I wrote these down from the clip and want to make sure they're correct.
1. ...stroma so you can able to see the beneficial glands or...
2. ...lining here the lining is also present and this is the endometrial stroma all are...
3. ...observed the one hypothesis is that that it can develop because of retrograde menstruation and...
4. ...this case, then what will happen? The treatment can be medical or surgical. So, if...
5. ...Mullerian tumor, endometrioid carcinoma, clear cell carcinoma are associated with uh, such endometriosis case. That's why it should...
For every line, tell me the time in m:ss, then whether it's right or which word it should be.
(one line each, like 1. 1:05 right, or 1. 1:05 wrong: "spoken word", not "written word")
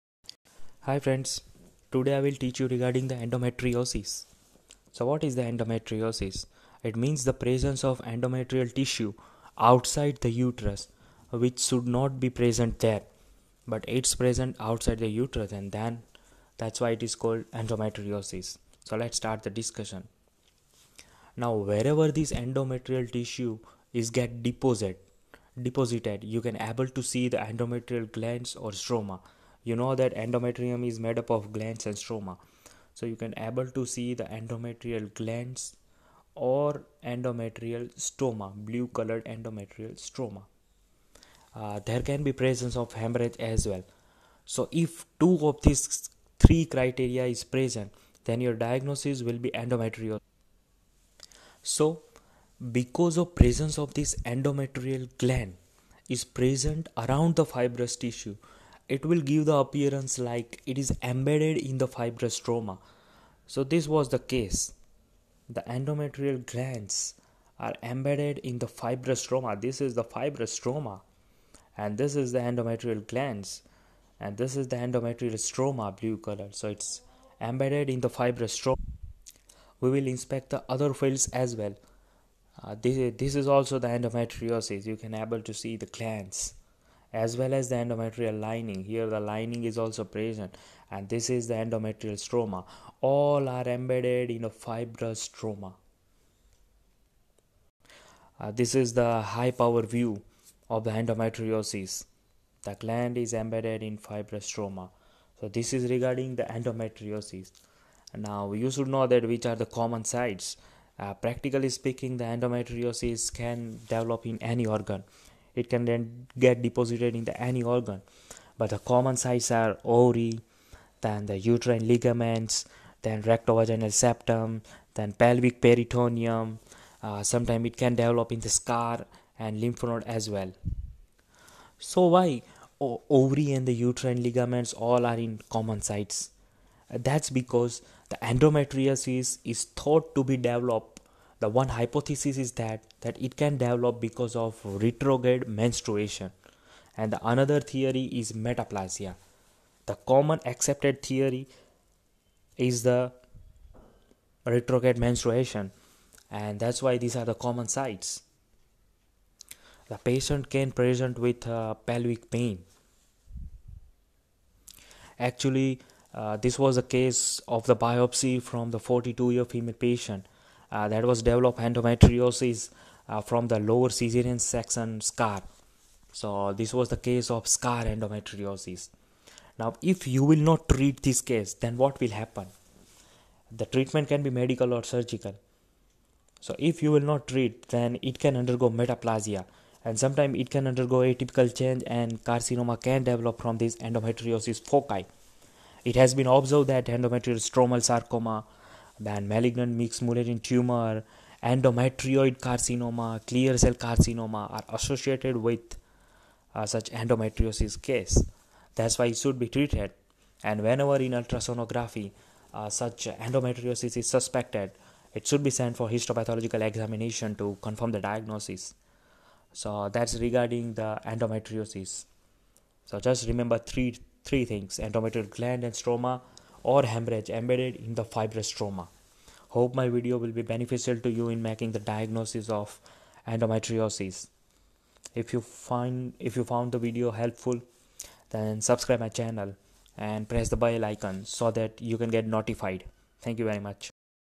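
1. 0:31 wrong: "endometrial", not "beneficial"
2. 1:28 right
3. 2:20 wrong: "developed", not "observed"
4. 3:01 right
5. 3:20 right.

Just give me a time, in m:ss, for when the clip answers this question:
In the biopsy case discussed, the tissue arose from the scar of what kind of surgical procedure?
2:53.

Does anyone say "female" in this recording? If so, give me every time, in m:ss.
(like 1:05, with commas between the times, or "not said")
2:49.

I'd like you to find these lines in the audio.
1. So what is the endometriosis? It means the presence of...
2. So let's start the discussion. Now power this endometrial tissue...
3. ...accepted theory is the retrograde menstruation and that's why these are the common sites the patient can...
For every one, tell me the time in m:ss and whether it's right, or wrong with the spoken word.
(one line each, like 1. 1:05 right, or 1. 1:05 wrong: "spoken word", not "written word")
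1. 0:04 right
2. 0:18 wrong: "wherever", not "power"
3. 2:30 right.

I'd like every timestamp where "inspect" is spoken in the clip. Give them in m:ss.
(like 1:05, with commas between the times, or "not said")
1:20.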